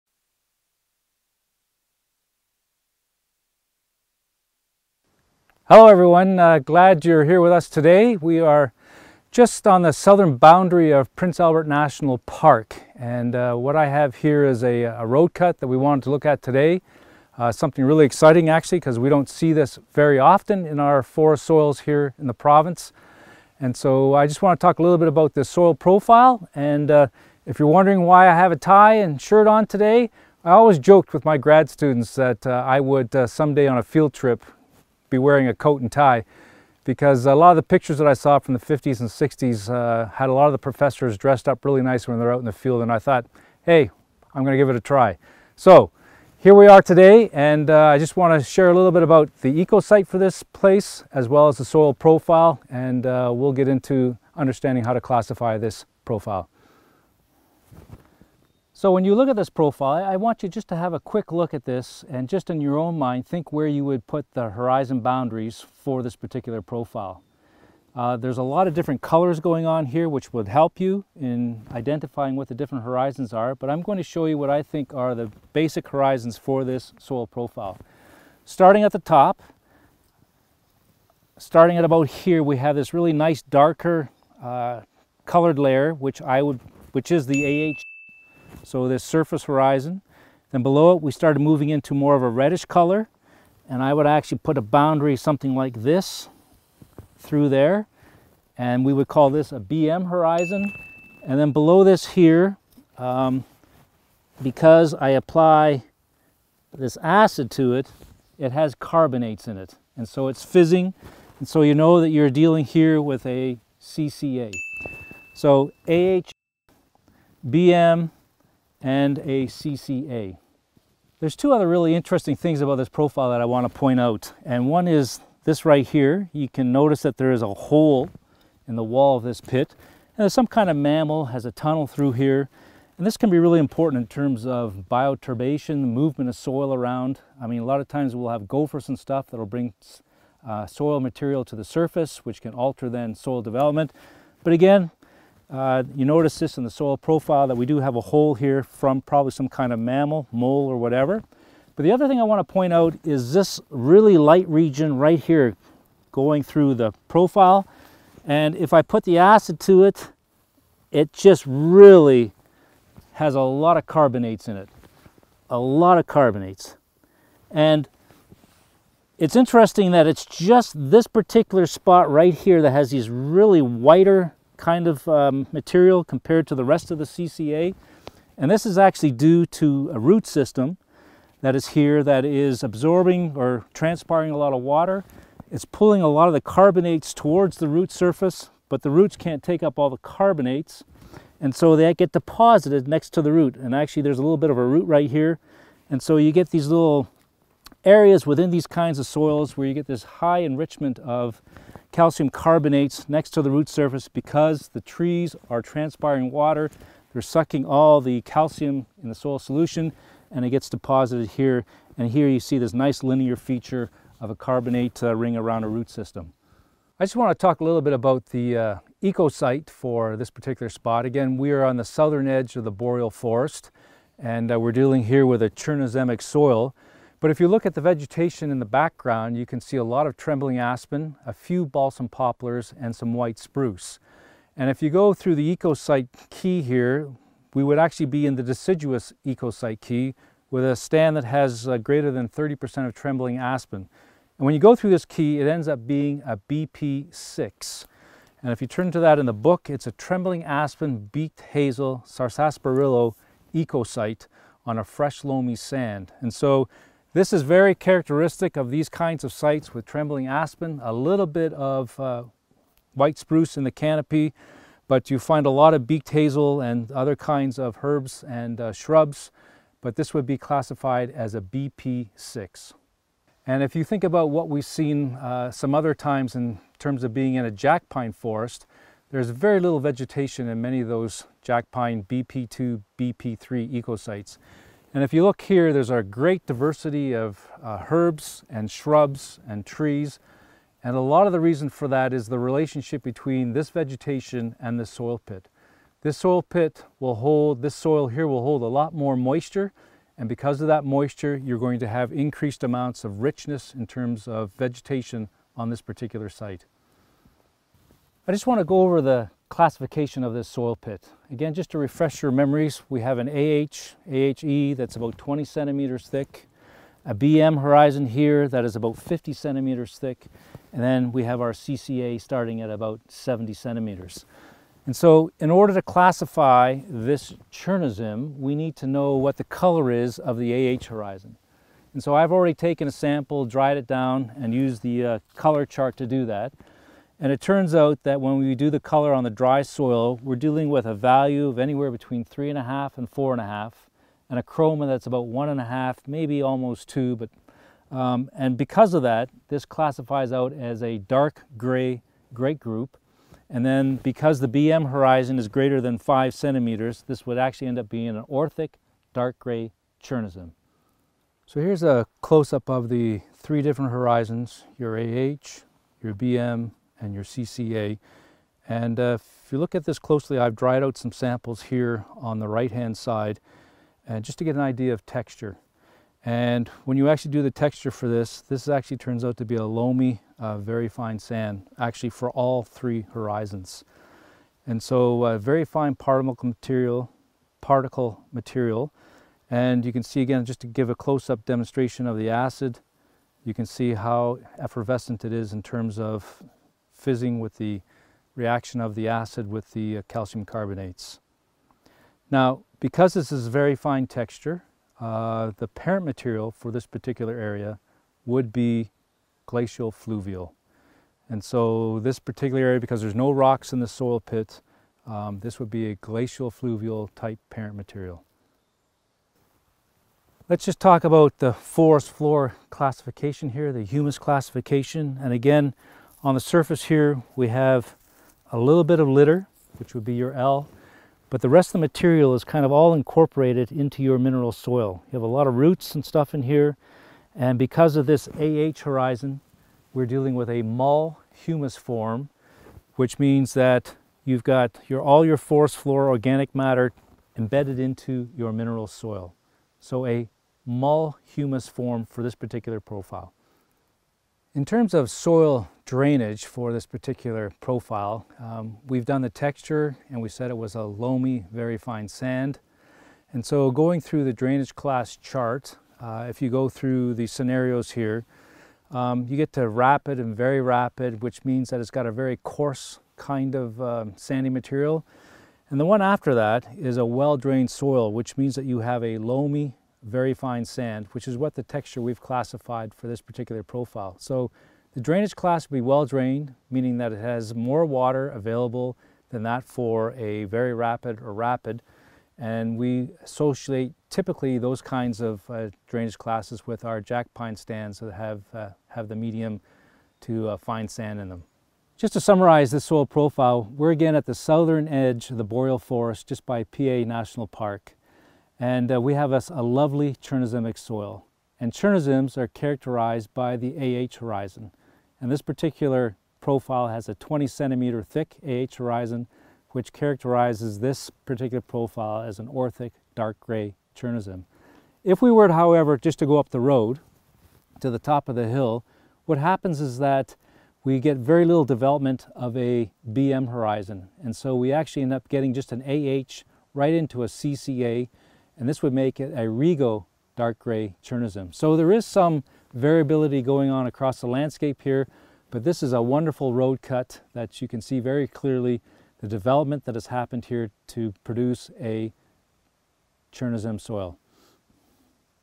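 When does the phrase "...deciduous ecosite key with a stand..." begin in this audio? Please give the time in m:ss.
3:58.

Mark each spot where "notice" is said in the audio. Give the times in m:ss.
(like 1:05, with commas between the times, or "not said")
2:06, 2:26.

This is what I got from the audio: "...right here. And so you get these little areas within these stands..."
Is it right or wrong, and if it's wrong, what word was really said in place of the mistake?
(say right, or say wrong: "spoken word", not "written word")
wrong: "kinds", not "stands".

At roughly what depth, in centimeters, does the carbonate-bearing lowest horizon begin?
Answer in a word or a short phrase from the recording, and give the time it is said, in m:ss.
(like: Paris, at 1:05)
70, at 5:23.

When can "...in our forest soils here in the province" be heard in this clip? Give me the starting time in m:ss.
0:20.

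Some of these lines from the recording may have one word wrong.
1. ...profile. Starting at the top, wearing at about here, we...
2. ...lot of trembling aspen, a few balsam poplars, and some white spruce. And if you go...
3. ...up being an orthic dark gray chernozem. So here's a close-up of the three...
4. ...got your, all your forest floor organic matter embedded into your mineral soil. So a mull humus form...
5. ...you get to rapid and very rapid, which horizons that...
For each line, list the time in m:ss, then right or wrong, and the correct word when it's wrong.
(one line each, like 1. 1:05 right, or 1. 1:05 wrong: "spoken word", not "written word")
1. 1:17 wrong: "starting", not "wearing"
2. 3:49 right
3. 5:57 right
4. 7:24 right
5. 7:49 wrong: "means", not "horizons".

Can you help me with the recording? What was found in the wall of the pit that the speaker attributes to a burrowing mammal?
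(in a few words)
A tunnel.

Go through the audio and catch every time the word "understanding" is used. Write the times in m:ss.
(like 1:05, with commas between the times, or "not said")
0:54.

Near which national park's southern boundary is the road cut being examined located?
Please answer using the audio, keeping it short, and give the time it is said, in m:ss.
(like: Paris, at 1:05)
Prince Albert National Park, at 0:11.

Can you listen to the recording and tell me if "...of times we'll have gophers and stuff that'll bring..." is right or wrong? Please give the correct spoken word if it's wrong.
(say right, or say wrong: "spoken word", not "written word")
right.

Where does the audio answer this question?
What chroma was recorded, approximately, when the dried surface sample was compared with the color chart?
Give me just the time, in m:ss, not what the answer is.
5:45.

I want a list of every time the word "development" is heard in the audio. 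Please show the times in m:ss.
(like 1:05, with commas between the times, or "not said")
2:23, 8:51, 9:09.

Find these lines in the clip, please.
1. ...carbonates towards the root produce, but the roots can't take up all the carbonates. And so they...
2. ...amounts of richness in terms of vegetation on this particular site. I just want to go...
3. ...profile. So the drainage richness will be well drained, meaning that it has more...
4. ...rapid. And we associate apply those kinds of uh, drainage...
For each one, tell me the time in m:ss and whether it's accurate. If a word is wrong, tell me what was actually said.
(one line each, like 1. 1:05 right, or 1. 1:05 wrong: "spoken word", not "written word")
1. 3:06 wrong: "surface", not "produce"
2. 5:02 right
3. 8:03 wrong: "class", not "richness"
4. 8:11 wrong: "typically", not "apply".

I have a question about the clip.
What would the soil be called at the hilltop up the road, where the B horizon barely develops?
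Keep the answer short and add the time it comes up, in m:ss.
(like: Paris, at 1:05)
Rego dark gray chernozem, at 8:59.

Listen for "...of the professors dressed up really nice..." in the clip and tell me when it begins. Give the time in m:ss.
0:40.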